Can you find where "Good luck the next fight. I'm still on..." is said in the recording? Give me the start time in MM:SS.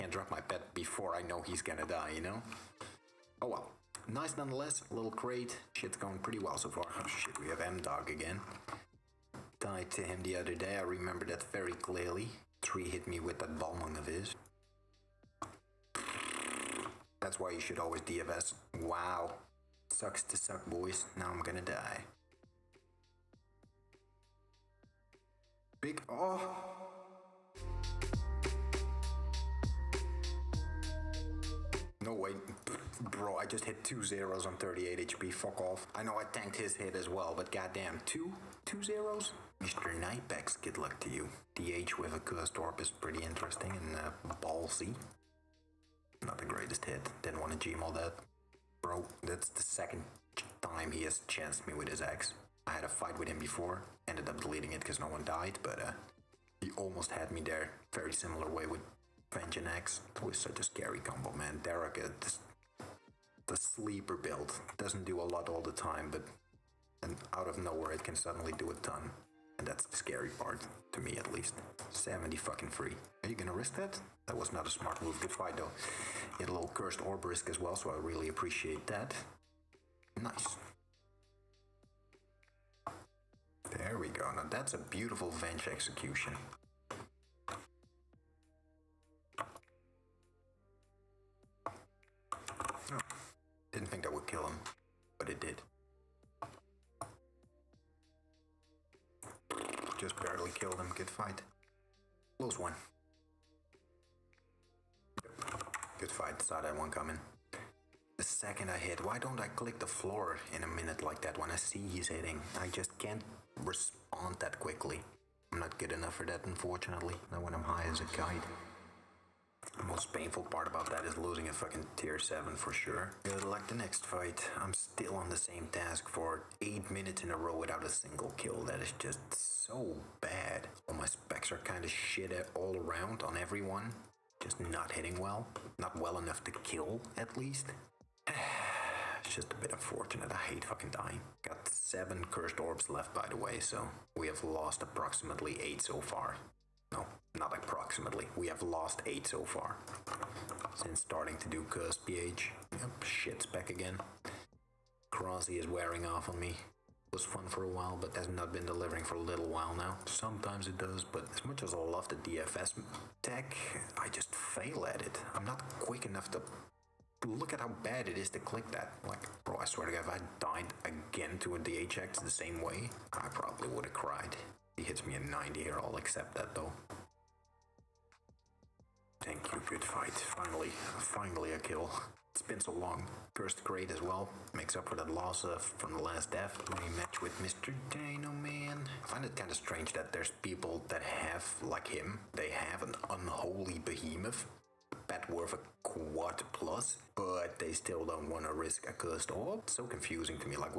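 02:03.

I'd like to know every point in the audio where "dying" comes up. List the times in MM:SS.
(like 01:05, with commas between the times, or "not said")
02:20.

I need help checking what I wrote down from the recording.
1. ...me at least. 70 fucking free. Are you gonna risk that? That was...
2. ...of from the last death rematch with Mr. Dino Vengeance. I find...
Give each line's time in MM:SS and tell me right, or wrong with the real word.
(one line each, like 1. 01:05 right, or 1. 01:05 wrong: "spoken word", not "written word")
1. 01:11 right
2. 03:05 wrong: "Man", not "Vengeance".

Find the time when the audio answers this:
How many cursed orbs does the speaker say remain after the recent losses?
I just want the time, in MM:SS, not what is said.
02:21.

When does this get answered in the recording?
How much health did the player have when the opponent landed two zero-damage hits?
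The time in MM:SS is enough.
00:34.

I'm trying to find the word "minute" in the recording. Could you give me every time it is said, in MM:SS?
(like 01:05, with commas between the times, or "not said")
01:50, 02:06.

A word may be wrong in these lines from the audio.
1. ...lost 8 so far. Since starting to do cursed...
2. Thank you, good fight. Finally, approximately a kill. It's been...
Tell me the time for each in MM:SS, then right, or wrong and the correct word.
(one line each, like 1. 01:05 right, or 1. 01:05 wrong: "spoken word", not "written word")
1. 02:28 right
2. 02:59 wrong: "finally", not "approximately".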